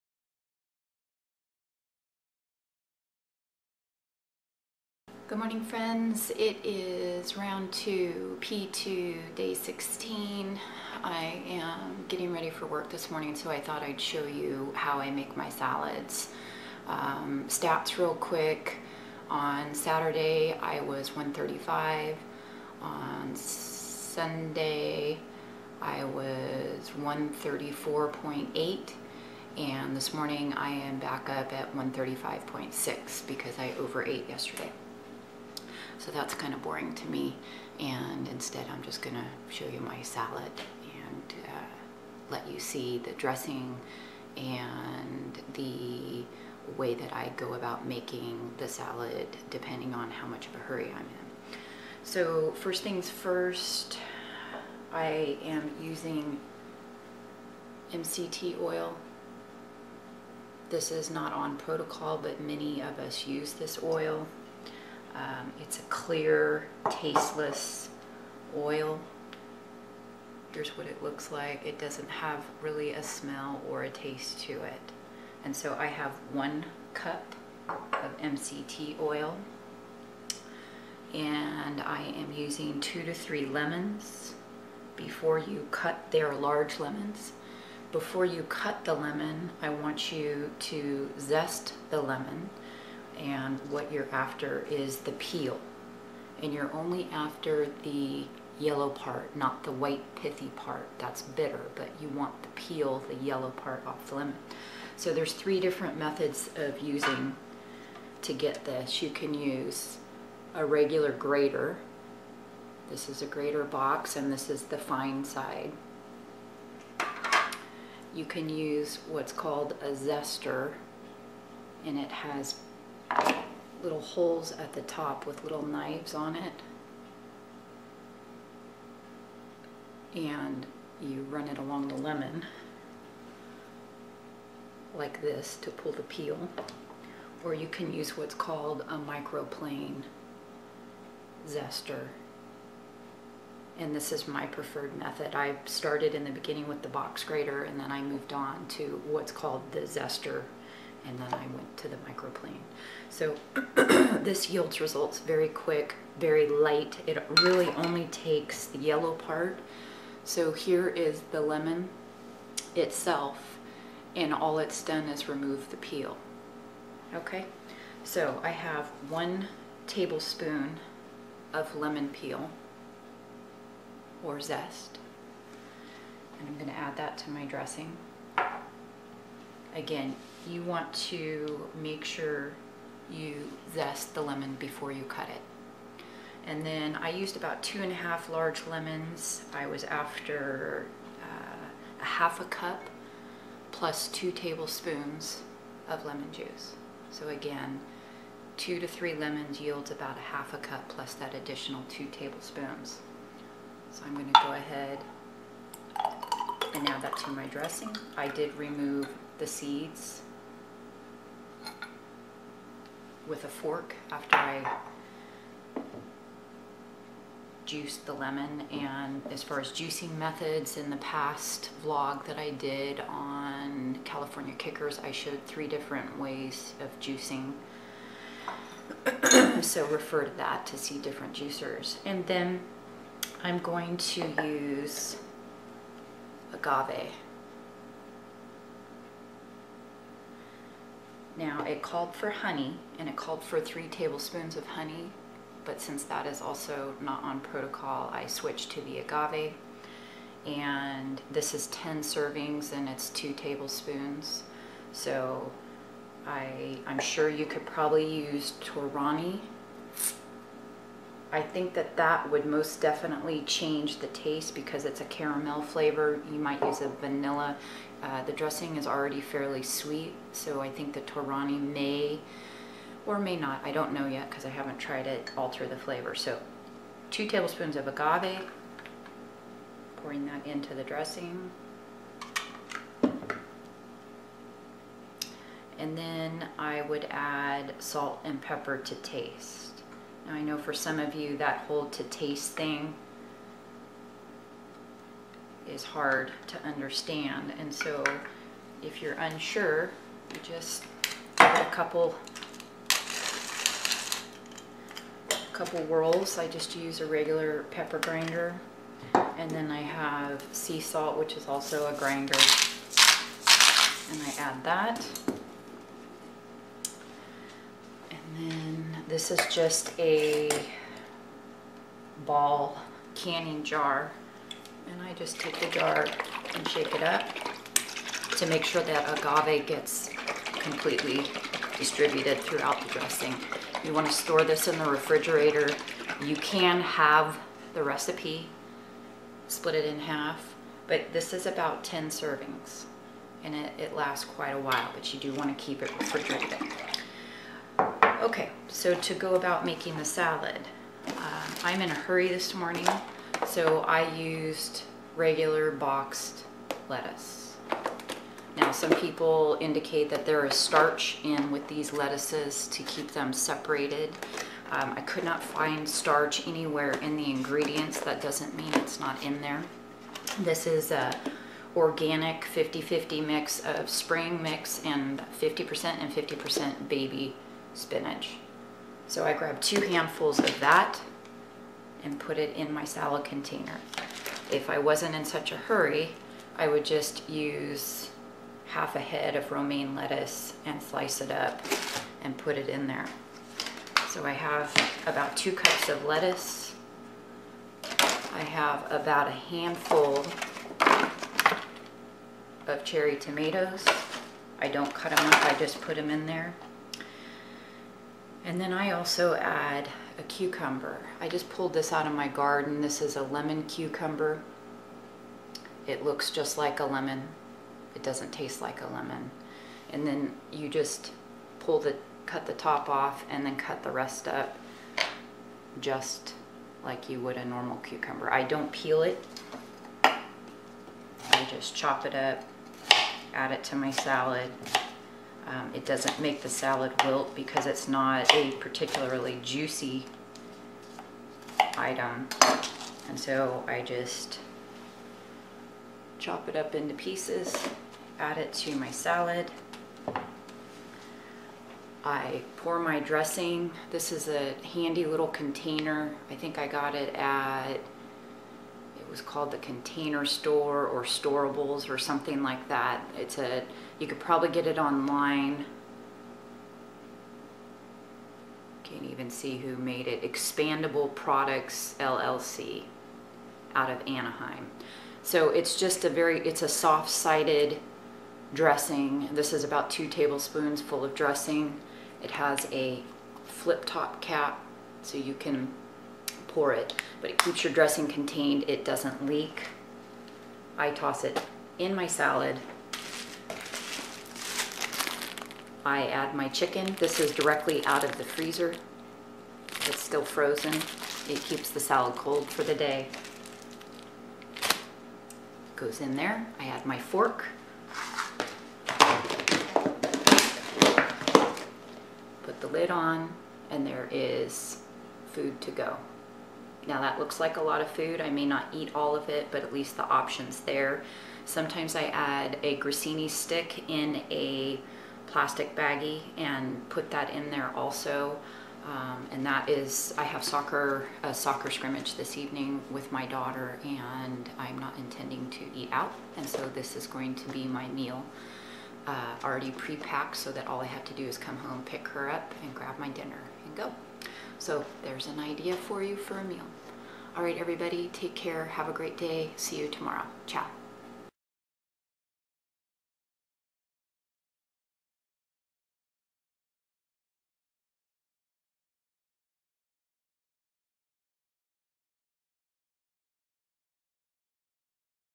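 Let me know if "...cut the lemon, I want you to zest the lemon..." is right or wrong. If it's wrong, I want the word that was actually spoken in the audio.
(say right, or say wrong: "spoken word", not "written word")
right.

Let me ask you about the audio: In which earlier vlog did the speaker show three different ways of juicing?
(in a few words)
California kickers.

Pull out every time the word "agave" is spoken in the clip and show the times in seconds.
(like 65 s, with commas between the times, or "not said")
236 s, 248 s, 277 s, 329 s.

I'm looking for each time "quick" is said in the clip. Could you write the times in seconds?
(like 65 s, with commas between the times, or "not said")
18 s, 155 s.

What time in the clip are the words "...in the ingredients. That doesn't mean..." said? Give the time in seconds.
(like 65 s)
367 s.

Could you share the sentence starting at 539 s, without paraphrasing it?
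Uh, already pre-packed so that all I have to do is come home, pick her up, and grab my dinner and go.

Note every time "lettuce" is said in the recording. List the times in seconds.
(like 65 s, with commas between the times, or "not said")
356 s, 361 s, 389 s, 396 s.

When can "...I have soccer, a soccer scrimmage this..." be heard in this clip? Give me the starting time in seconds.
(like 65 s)
530 s.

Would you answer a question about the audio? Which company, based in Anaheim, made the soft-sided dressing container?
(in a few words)
Expandable Products LLC.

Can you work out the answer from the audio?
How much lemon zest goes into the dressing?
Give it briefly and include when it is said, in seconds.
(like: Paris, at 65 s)
1 tablespoon, at 169 s.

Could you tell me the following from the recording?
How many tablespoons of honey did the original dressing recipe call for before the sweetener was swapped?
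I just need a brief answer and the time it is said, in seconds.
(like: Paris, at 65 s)
3, at 243 s.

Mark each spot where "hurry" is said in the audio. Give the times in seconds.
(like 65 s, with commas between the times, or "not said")
50 s, 351 s, 385 s.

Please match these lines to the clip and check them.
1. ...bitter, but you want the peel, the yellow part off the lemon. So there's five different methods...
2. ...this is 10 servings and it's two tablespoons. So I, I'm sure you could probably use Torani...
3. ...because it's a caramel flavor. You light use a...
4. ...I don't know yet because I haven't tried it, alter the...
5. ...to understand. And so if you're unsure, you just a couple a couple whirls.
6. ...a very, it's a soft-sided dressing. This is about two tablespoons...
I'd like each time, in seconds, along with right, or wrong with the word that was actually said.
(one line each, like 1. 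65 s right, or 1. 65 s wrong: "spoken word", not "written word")
1. 101 s wrong: "three", not "five"
2. 251 s right
3. 264 s wrong: "might", not "light"
4. 273 s right
5. 296 s right
6. 476 s right.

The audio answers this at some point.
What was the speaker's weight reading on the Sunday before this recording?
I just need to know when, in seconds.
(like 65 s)
26 s.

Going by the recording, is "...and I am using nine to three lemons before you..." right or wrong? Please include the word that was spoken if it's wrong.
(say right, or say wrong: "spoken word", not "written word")
wrong: "two", not "nine".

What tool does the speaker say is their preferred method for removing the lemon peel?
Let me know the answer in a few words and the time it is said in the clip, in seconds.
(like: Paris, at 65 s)
microplane zester, at 138 s.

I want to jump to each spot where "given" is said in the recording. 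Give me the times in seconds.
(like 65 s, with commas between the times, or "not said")
not said.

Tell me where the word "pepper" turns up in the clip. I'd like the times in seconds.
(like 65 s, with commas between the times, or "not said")
288 s, 307 s.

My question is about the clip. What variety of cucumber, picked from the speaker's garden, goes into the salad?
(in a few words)
lemon cucumber.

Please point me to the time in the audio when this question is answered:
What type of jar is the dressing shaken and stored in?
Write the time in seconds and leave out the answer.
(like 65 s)
322 s.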